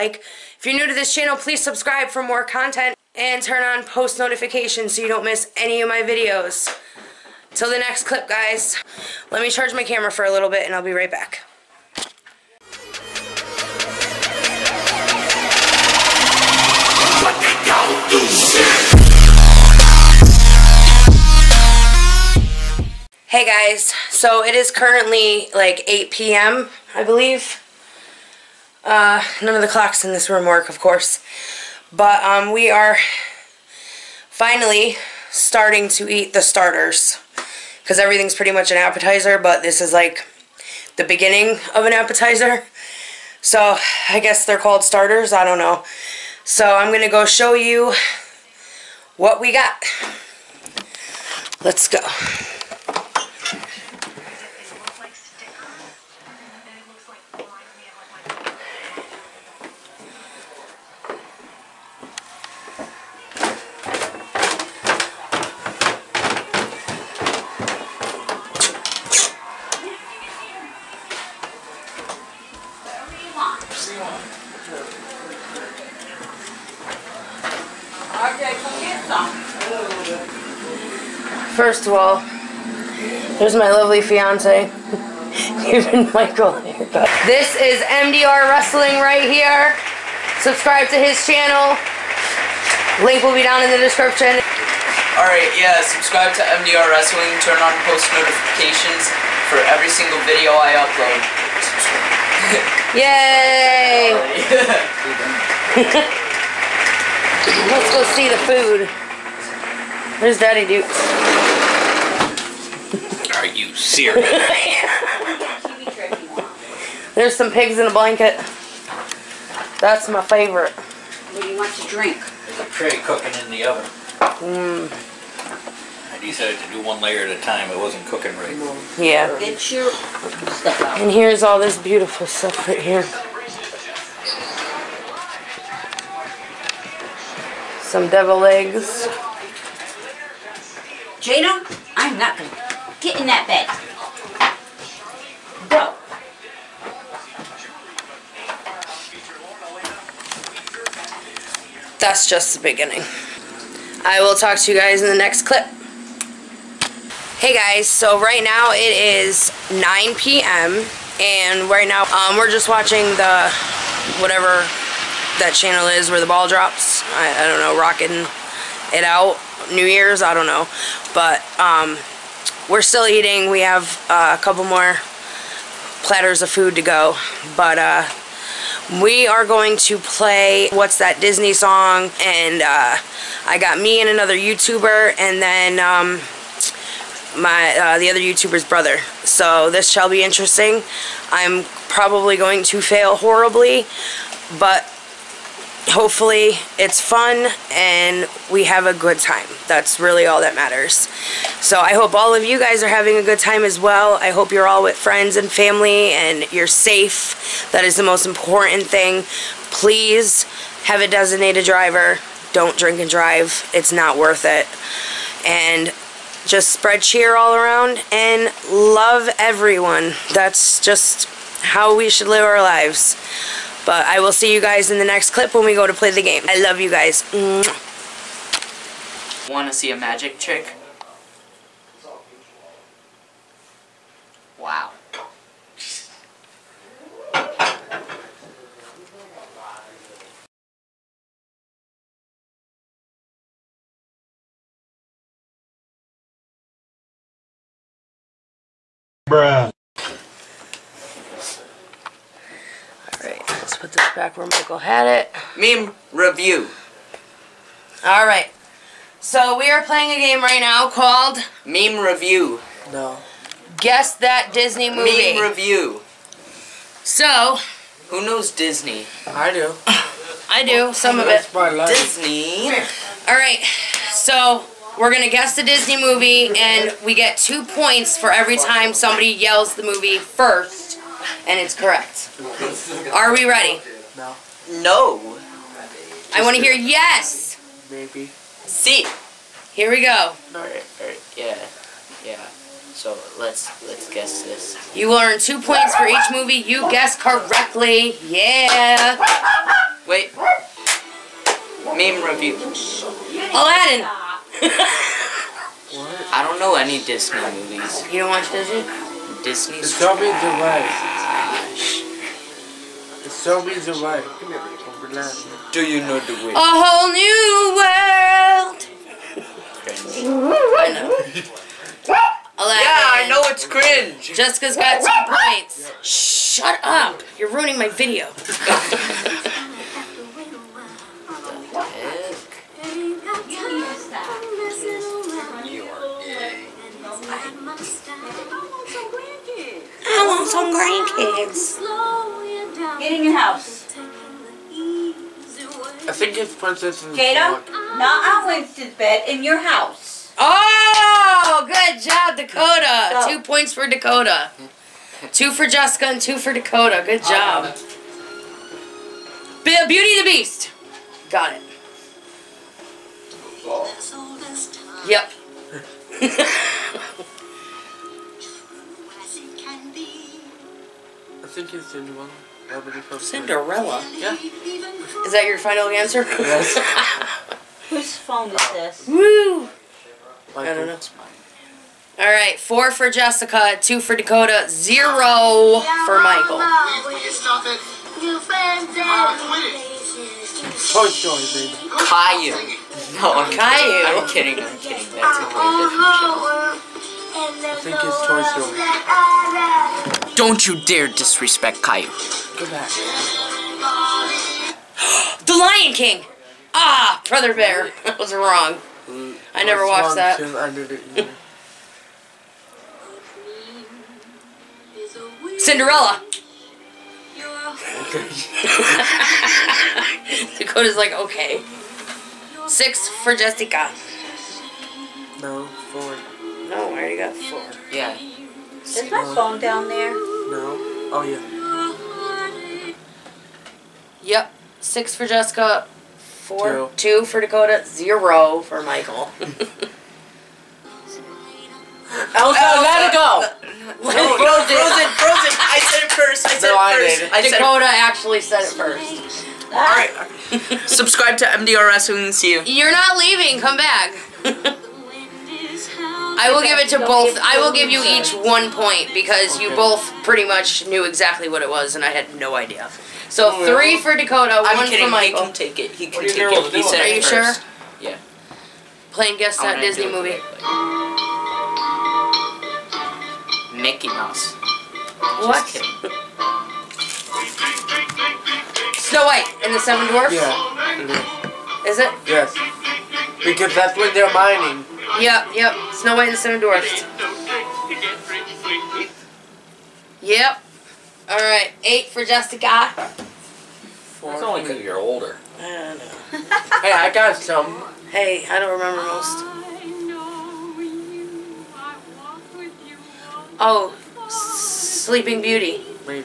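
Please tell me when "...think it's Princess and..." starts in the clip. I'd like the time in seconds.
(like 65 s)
346 s.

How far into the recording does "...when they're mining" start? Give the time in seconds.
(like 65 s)
483 s.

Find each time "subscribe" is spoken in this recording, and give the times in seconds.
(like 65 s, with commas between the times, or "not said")
1 s, 90 s, 95 s, 450 s.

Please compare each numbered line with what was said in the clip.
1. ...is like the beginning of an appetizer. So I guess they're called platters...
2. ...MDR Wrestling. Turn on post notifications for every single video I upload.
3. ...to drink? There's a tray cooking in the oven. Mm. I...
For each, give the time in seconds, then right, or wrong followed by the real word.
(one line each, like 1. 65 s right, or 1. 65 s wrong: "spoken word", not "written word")
1. 39 s wrong: "starters", not "platters"
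2. 96 s right
3. 121 s right.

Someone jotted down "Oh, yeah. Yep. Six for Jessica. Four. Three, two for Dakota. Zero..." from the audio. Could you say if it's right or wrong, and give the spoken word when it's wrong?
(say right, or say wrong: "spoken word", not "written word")
wrong: "Two", not "Three".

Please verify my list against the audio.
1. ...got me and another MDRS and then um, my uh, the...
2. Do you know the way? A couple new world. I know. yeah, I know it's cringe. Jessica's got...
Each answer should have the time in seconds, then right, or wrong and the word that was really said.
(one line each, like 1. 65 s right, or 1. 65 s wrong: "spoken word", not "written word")
1. 183 s wrong: "YouTuber", not "MDRS"
2. 315 s wrong: "whole", not "couple".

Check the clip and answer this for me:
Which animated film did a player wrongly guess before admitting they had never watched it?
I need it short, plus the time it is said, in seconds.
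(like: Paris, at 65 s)
Brother Bear, at 407 s.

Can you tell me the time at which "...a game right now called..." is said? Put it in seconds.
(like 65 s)
260 s.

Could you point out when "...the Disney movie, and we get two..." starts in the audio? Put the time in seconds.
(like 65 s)
275 s.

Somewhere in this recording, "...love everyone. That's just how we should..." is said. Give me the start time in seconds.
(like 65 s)
218 s.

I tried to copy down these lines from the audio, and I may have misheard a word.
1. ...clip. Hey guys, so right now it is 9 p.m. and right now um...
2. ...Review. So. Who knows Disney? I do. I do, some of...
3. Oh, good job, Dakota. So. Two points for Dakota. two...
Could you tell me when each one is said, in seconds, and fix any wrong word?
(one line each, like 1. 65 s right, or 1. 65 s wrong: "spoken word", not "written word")
1. 155 s right
2. 265 s right
3. 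350 s right.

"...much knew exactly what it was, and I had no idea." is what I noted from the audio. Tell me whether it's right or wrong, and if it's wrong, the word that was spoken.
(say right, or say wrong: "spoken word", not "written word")
right.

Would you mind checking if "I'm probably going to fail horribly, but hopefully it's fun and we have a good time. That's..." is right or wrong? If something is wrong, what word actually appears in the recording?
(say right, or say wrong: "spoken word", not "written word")
right.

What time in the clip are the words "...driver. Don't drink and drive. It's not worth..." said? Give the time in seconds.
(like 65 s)
211 s.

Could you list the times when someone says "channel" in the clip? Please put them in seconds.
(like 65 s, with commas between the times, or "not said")
1 s, 91 s, 165 s.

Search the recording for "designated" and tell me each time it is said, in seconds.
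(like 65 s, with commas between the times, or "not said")
211 s.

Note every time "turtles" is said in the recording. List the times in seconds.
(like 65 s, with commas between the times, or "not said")
not said.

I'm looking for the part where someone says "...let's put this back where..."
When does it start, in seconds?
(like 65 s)
253 s.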